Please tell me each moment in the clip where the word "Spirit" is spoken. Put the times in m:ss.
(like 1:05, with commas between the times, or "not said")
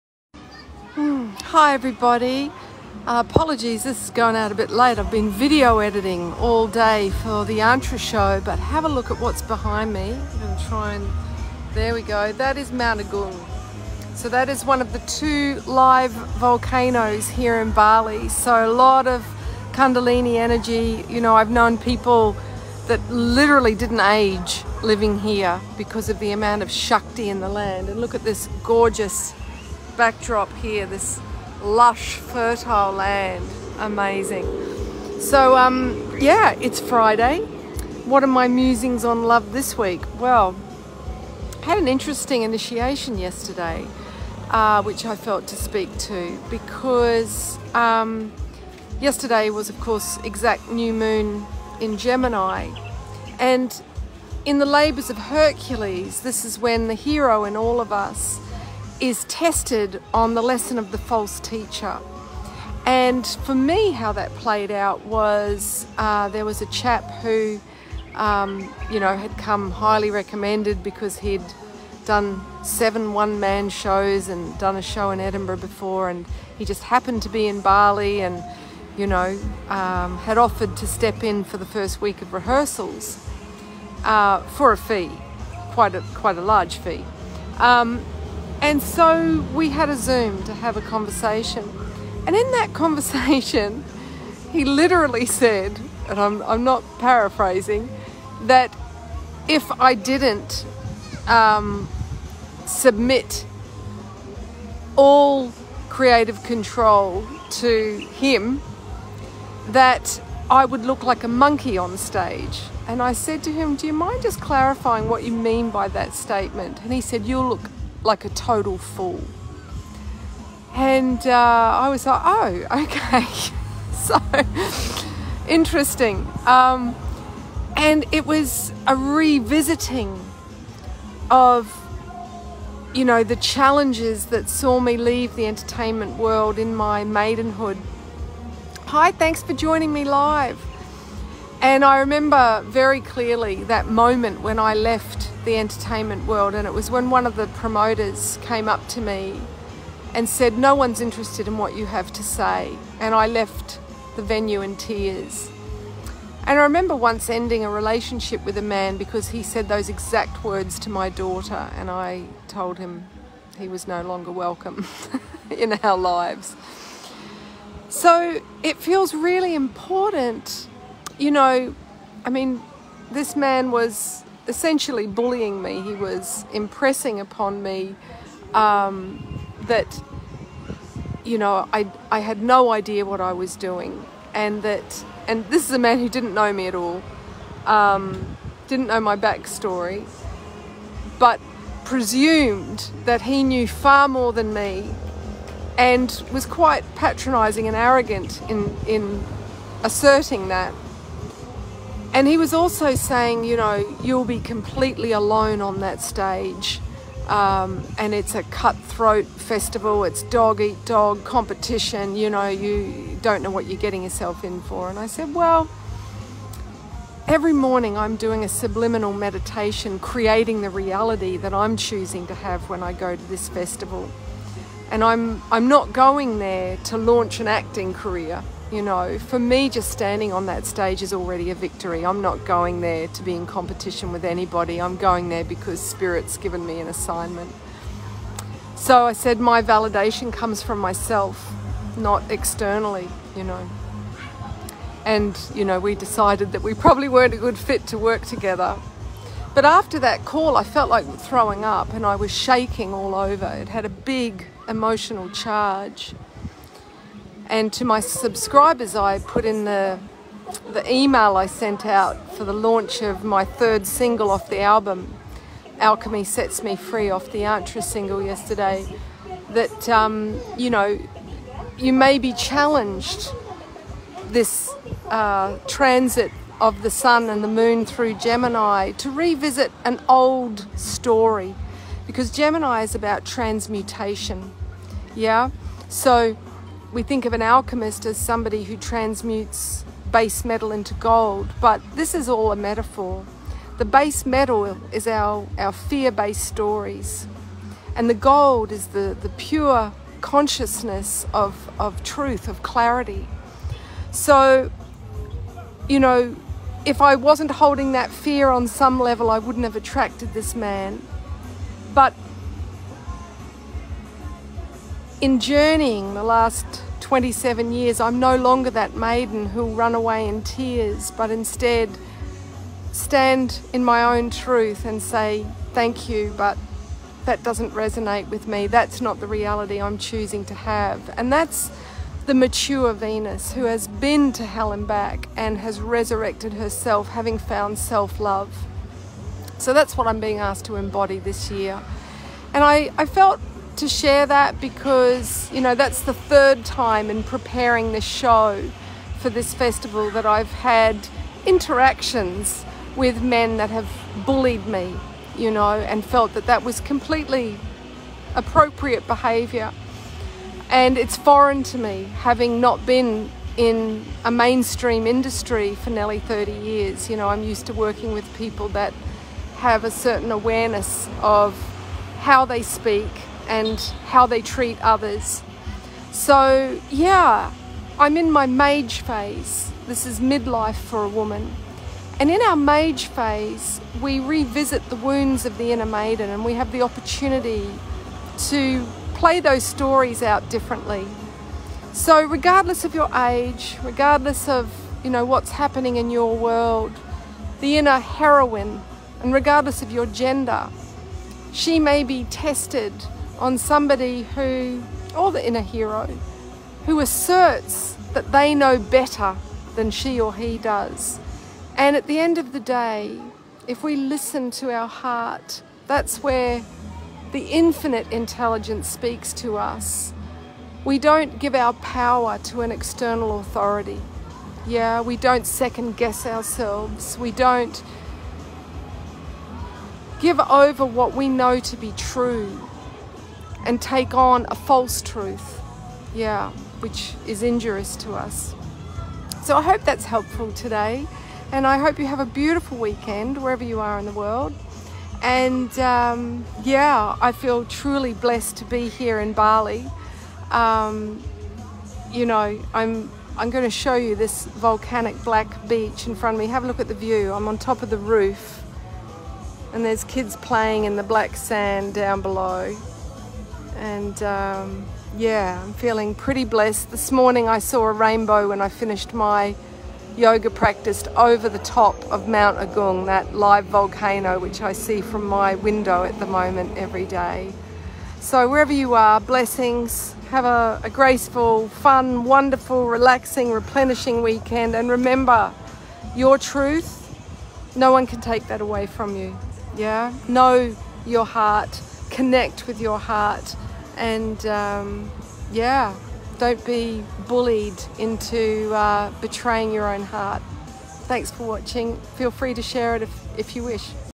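3:55.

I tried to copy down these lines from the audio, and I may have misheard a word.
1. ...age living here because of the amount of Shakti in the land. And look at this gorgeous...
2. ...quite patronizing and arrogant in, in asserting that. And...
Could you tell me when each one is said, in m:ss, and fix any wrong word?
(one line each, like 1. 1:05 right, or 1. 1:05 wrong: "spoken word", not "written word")
1. 0:24 right
2. 3:16 right.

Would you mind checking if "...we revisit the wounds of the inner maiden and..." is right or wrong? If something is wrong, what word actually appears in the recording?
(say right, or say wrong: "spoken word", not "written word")
right.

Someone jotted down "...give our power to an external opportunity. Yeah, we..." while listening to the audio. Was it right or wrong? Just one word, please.
wrong.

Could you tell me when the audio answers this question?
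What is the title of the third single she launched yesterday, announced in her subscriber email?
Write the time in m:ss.
4:25.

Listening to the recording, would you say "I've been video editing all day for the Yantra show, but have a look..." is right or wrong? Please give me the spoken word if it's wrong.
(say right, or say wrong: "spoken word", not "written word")
right.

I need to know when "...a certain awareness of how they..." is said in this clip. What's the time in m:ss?
6:09.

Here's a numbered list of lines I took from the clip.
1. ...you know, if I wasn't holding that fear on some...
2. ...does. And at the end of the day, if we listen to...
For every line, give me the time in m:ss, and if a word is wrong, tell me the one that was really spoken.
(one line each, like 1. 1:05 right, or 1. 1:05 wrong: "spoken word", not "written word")
1. 5:05 right
2. 6:50 right.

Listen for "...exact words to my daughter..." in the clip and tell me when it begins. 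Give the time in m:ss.
2:39.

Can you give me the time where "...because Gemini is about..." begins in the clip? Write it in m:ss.
4:42.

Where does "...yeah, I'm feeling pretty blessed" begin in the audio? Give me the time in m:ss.
7:45.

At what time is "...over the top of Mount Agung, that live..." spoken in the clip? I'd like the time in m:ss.
7:51.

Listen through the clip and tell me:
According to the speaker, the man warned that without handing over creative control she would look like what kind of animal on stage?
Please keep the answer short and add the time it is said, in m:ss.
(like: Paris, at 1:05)
A monkey, at 1:51.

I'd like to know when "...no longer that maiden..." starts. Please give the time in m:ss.
5:18.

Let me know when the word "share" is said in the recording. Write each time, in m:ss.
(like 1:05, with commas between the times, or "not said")
5:43, 8:22.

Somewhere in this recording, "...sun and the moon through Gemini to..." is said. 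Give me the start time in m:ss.
4:36.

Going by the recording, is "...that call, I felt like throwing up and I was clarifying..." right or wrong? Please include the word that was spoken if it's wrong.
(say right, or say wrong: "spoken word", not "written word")
wrong: "shaking", not "clarifying".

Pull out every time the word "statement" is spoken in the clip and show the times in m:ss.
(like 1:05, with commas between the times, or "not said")
1:56.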